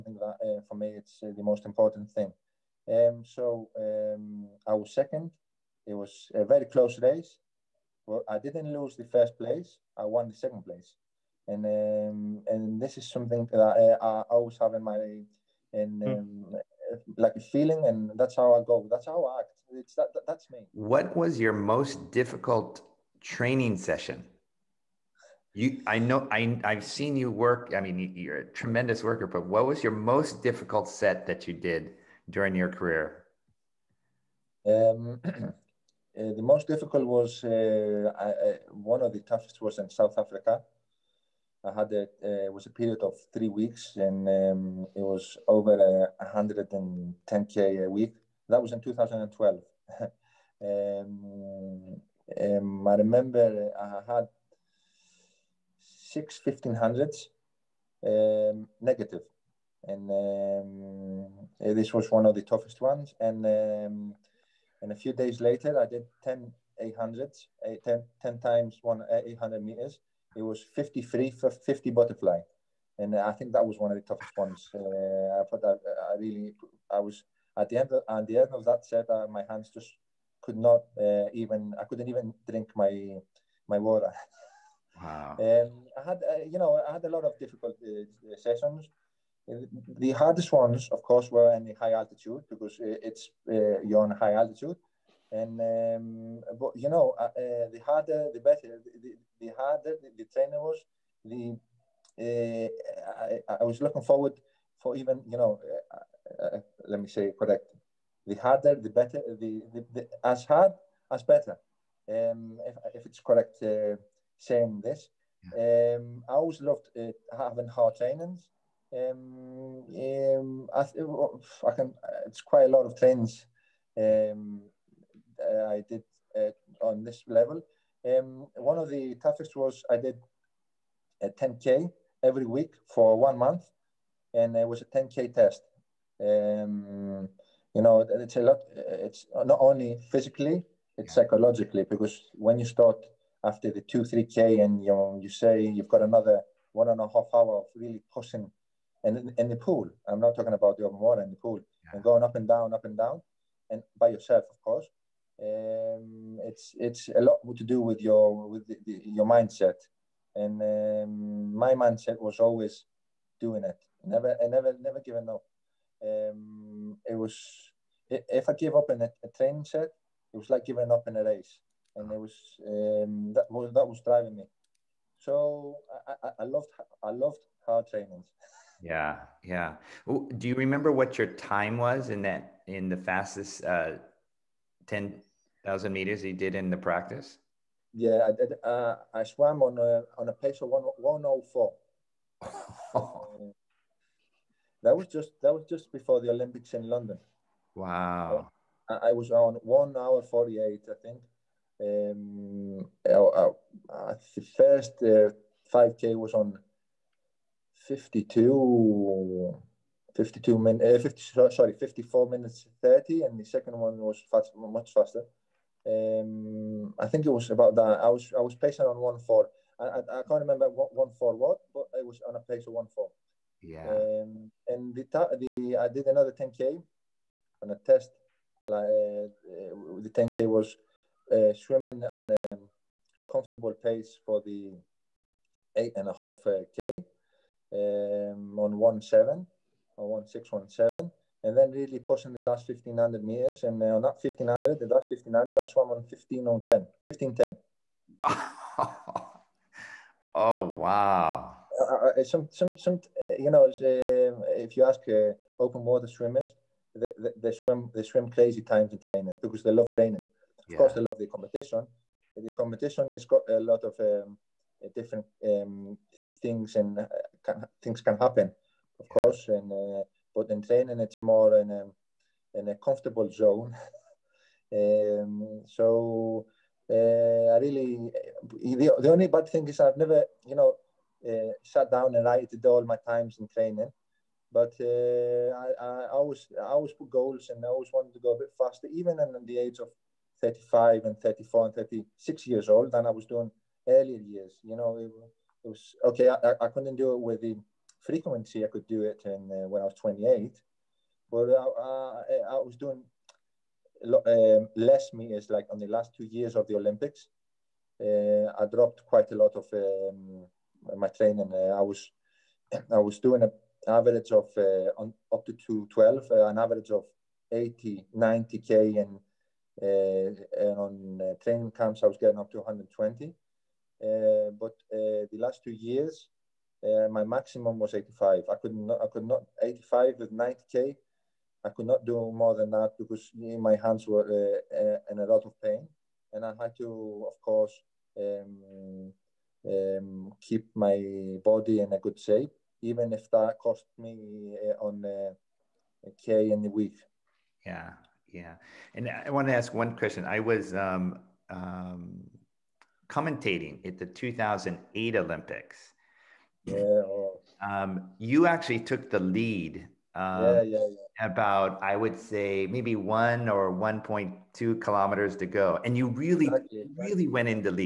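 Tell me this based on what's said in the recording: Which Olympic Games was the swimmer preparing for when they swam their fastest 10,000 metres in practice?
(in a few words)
London.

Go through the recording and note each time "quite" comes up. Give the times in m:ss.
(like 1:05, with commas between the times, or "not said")
2:02, 5:09.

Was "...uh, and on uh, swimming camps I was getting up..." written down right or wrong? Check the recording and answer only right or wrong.
wrong.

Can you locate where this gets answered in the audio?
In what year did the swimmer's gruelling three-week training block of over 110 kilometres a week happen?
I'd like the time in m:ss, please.
0:48.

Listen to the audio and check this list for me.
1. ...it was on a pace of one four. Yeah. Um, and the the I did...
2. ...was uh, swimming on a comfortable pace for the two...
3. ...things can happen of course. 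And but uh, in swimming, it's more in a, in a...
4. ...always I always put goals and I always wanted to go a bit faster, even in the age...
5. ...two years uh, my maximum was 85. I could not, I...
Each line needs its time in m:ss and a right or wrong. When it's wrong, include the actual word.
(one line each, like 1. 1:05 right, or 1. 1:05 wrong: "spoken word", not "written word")
1. 3:41 right
2. 3:50 wrong: "eight", not "two"
3. 4:27 wrong: "training", not "swimming"
4. 4:46 right
5. 5:25 right.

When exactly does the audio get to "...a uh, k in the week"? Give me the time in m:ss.
5:45.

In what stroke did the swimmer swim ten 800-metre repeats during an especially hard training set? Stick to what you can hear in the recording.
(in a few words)
Butterfly.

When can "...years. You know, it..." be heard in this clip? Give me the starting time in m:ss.
4:54.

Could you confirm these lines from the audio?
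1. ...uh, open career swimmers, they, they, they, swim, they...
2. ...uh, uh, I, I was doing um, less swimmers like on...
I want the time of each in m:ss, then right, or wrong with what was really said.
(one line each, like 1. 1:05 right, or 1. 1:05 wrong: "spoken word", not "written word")
1. 4:15 wrong: "water", not "career"
2. 5:01 wrong: "meters", not "swimmers".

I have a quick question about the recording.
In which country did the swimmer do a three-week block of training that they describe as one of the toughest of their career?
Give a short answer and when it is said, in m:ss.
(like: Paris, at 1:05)
South Africa, at 0:39.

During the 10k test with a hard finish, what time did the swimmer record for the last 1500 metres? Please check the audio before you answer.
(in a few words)
15:10.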